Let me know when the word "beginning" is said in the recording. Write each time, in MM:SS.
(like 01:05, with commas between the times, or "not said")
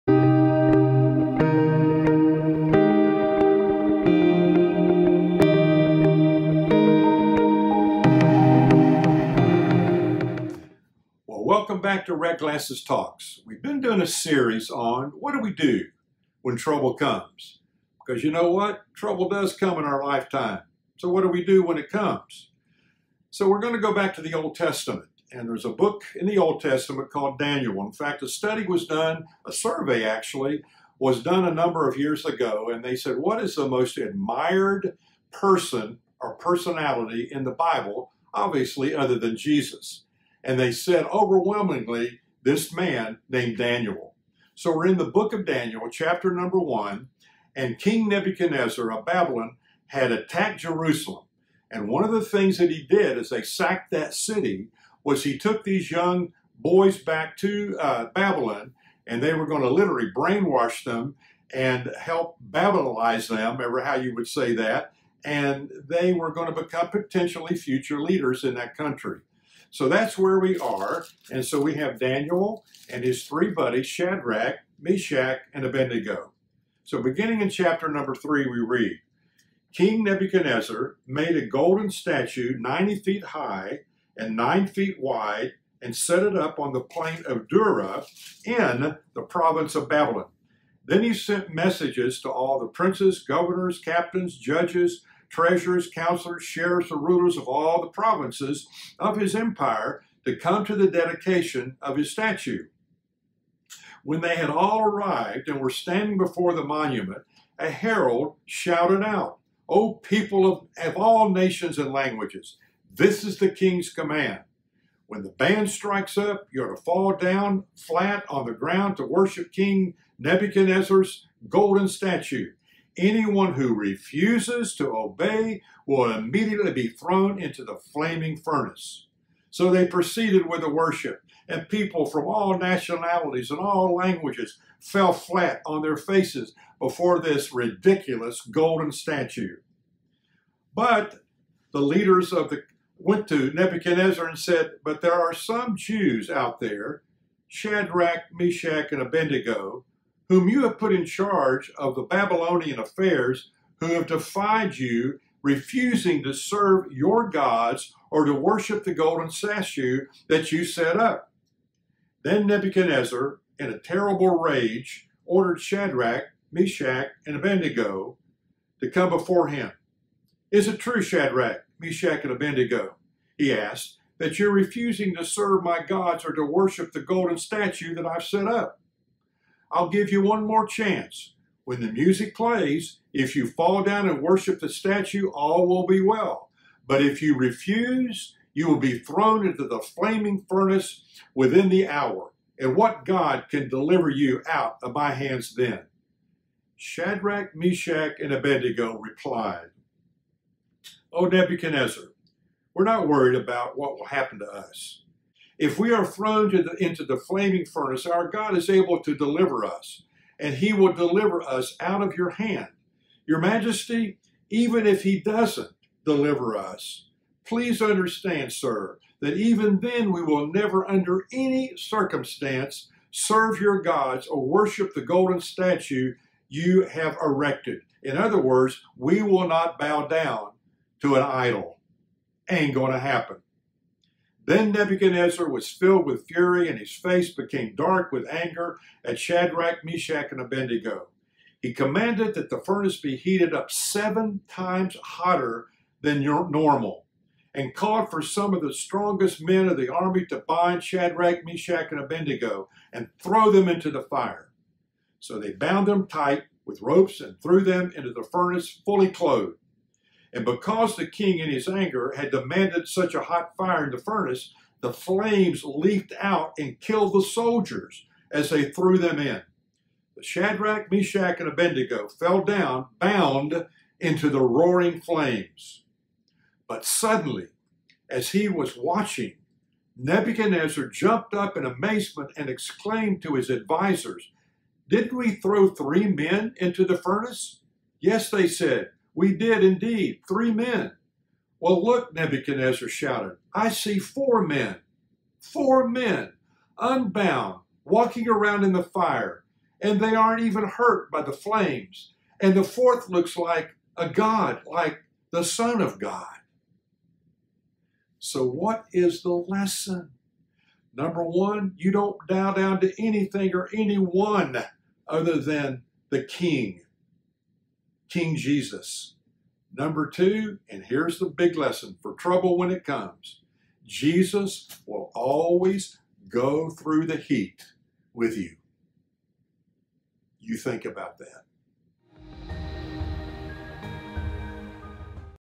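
01:17.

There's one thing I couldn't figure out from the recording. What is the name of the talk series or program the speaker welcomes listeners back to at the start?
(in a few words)
Red Glasses Talks.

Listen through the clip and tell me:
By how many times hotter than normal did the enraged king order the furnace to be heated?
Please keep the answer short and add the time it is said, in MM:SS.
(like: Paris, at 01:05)
7, at 04:03.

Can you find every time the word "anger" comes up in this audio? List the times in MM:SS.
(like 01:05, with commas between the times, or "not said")
03:58, 04:21.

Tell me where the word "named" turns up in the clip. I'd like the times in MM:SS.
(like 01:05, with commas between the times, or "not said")
00:43.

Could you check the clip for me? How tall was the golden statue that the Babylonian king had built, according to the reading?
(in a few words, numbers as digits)
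90 feet.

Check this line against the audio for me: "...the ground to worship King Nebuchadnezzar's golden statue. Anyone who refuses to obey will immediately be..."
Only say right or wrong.
right.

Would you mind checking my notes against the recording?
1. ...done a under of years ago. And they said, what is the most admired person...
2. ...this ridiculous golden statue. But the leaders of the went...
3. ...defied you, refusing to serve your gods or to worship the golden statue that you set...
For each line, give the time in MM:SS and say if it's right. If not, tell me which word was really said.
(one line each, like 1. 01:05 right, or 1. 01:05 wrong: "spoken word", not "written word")
1. 00:31 wrong: "number", not "under"
2. 02:17 right
3. 02:34 right.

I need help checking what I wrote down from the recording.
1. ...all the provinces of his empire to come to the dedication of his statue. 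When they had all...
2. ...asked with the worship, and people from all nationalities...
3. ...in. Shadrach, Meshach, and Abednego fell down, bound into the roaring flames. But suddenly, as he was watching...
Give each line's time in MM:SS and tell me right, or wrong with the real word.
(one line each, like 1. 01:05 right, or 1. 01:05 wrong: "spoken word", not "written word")
1. 01:37 right
2. 02:09 wrong: "proceeded", not "asked"
3. 04:29 right.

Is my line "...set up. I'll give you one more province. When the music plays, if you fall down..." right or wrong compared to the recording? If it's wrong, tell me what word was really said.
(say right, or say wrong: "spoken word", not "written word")
wrong: "chance", not "province".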